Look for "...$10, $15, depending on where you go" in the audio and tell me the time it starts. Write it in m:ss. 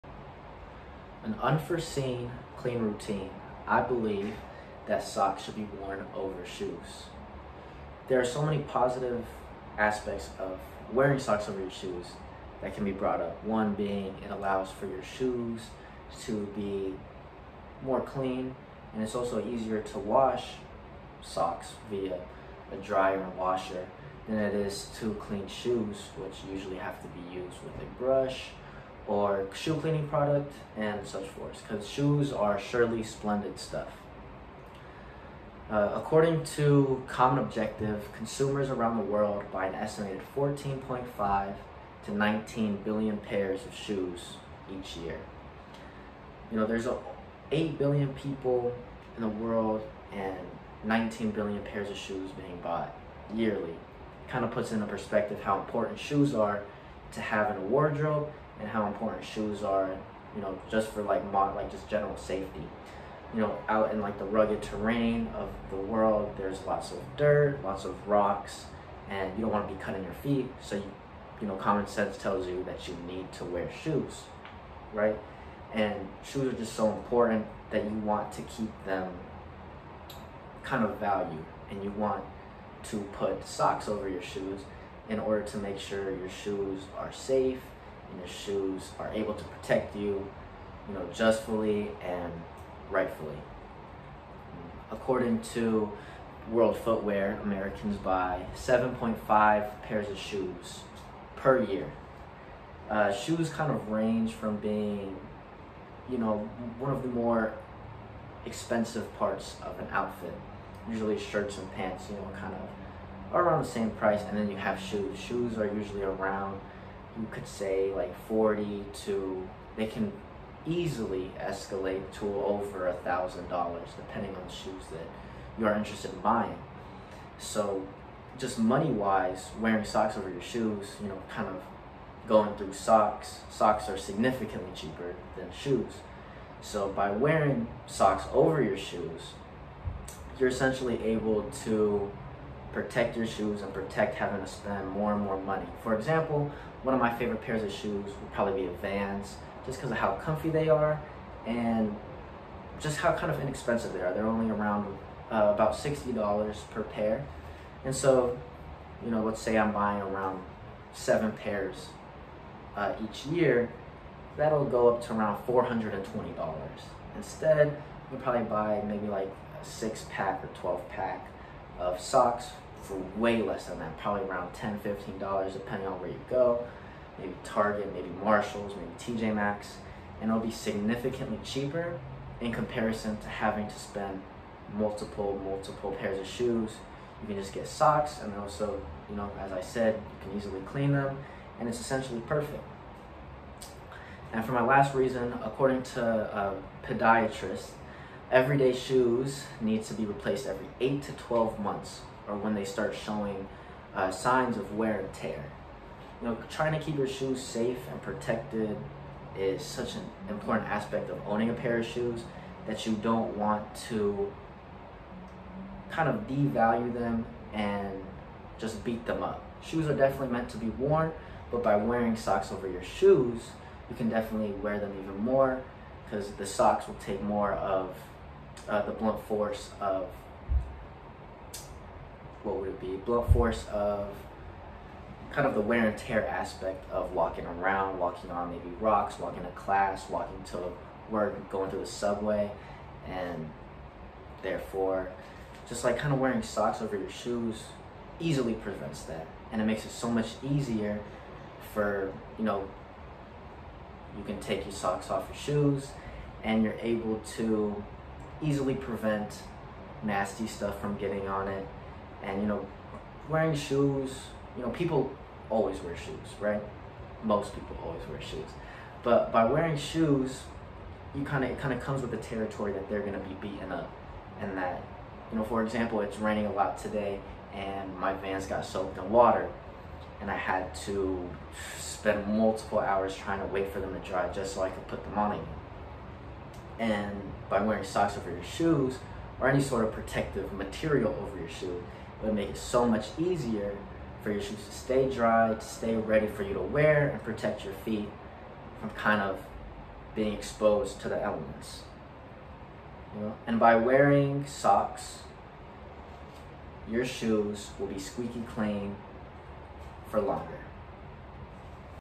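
2:54.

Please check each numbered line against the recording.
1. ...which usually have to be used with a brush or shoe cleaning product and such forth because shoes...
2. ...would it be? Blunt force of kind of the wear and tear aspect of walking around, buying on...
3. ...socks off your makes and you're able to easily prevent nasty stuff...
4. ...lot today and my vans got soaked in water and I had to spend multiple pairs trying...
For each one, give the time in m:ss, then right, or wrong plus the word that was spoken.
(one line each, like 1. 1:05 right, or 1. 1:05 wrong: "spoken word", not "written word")
1. 0:26 right
2. 3:52 wrong: "walking", not "buying"
3. 4:14 wrong: "shoes", not "makes"
4. 4:36 wrong: "hours", not "pairs".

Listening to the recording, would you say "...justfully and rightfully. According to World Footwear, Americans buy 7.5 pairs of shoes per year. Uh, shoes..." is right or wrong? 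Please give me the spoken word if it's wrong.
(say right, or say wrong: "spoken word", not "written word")
right.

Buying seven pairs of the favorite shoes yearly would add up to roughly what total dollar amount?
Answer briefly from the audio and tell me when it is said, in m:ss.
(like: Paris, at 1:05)
$420, at 2:45.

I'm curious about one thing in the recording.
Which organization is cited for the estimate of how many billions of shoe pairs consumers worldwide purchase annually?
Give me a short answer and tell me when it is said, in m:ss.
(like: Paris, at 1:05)
Common Objective, at 0:37.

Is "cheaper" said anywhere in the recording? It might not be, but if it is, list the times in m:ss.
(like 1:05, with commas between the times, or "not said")
2:14, 3:01.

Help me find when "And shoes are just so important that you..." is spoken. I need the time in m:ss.
1:15.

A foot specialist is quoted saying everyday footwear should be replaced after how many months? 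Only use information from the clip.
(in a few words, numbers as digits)
8 to 12 months.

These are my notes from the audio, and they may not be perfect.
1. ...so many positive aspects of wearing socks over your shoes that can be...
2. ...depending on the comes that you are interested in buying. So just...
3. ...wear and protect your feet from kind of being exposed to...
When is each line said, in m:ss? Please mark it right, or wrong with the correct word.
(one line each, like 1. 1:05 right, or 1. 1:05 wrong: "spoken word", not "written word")
1. 0:08 right
2. 2:03 wrong: "shoes", not "comes"
3. 4:56 right.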